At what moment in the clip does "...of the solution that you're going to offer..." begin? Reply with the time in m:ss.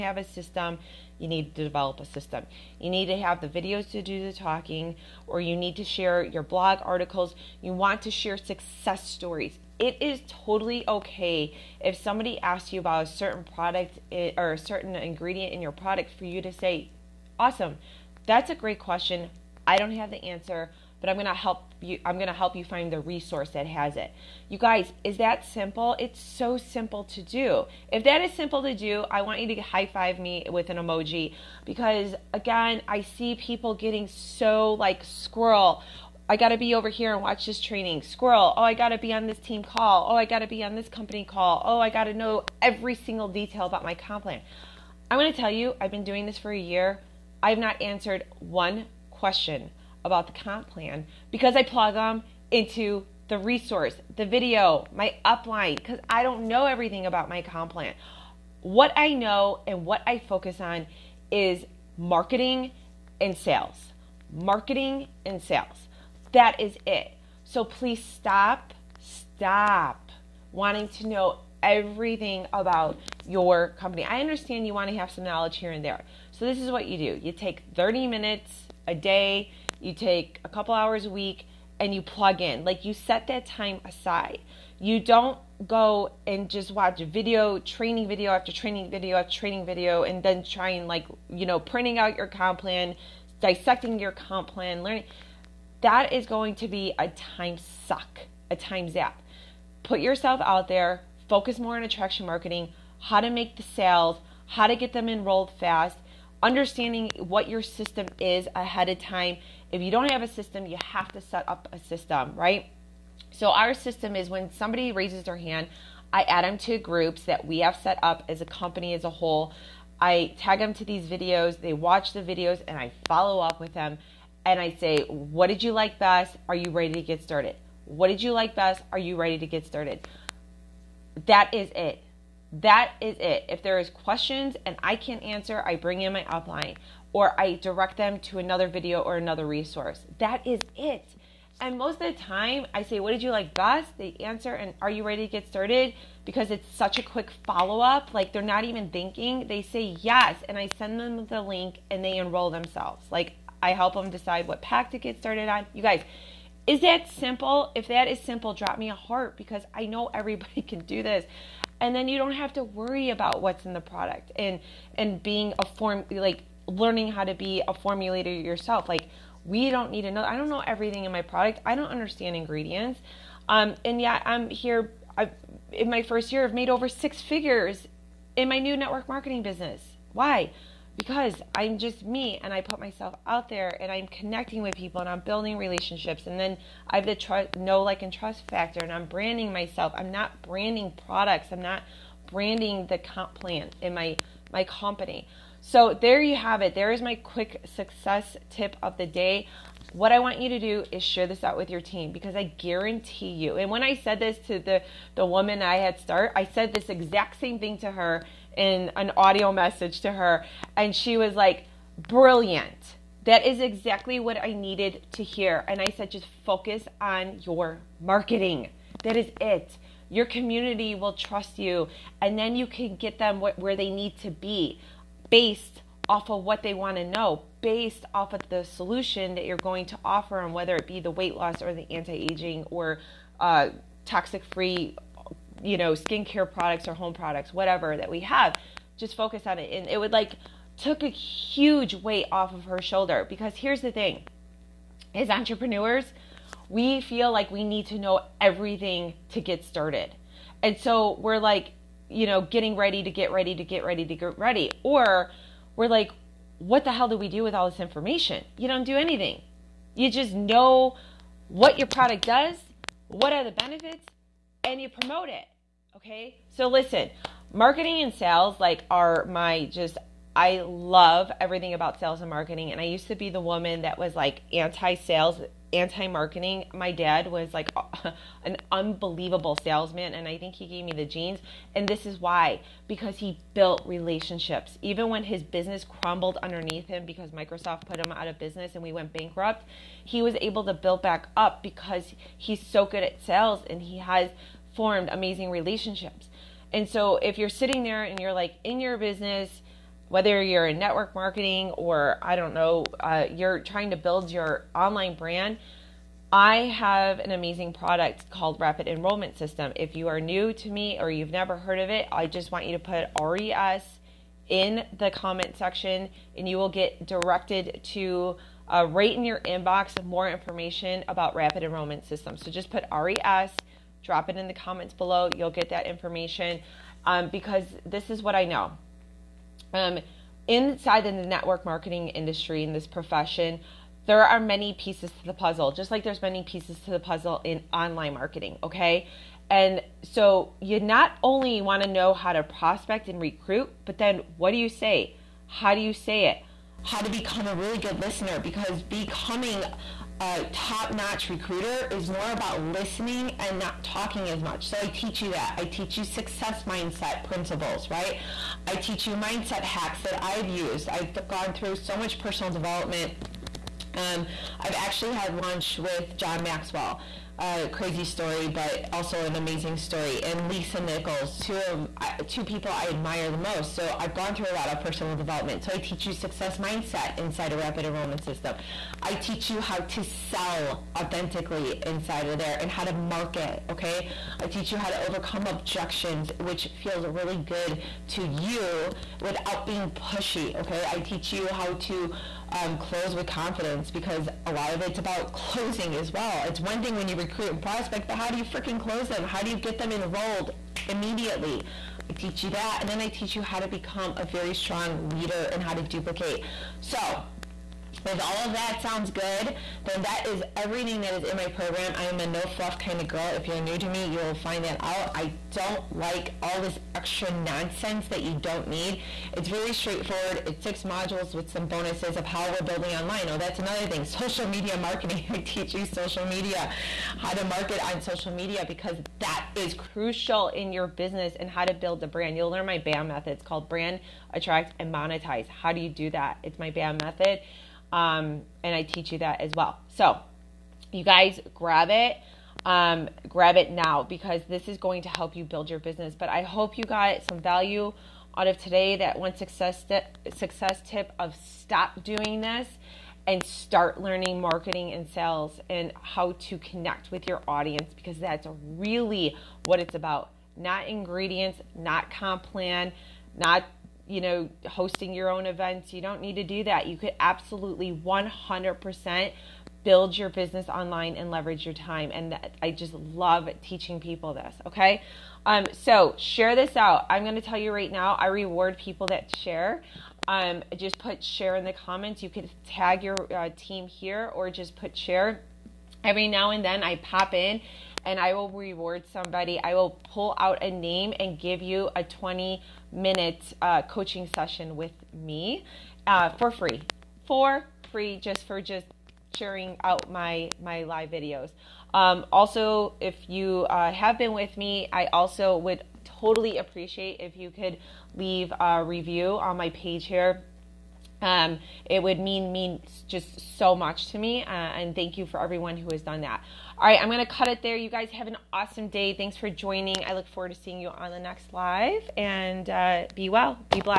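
3:48.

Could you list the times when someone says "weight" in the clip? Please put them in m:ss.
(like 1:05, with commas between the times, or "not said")
3:51, 4:01.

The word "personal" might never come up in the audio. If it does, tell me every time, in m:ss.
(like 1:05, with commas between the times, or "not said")
6:02, 6:14.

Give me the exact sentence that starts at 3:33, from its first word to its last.
That is exactly what I needed to hear.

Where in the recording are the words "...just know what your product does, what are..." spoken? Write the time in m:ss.
4:20.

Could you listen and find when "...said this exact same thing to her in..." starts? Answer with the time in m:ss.
3:26.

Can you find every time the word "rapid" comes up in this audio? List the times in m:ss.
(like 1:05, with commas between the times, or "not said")
5:08, 5:21, 6:17.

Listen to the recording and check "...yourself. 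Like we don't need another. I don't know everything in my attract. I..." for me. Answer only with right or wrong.
wrong.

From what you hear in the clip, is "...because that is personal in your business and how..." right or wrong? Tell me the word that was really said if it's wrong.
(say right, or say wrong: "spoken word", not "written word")
wrong: "crucial", not "personal".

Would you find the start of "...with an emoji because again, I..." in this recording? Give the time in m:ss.
0:30.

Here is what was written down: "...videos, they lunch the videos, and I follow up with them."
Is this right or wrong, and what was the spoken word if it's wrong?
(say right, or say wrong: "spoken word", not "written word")
wrong: "watch", not "lunch".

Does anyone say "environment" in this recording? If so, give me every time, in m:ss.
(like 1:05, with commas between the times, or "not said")
not said.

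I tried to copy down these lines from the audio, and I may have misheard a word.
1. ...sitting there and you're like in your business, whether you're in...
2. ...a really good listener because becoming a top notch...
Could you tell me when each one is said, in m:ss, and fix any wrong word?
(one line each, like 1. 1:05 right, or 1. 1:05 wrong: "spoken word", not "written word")
1. 4:57 right
2. 5:47 right.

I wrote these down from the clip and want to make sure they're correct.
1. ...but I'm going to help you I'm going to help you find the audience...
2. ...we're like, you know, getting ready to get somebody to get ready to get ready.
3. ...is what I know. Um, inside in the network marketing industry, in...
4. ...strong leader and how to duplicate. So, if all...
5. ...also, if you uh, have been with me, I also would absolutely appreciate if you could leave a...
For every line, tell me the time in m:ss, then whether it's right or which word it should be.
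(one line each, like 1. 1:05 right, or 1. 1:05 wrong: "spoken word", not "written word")
1. 0:21 wrong: "resource", not "audience"
2. 4:11 wrong: "ready", not "somebody"
3. 5:28 right
4. 6:44 right
5. 8:22 wrong: "totally", not "absolutely".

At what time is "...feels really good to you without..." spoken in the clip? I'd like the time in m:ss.
6:26.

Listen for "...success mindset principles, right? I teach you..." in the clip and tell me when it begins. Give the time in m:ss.
5:56.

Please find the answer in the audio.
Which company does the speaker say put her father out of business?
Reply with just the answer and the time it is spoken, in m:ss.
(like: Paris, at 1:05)
Microsoft, at 4:47.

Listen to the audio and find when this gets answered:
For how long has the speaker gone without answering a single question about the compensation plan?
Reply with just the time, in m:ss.
0:46.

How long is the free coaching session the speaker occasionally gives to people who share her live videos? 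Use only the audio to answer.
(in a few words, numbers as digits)
20 minutes.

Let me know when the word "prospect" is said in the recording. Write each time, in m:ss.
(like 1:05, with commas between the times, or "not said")
5:42, 6:37.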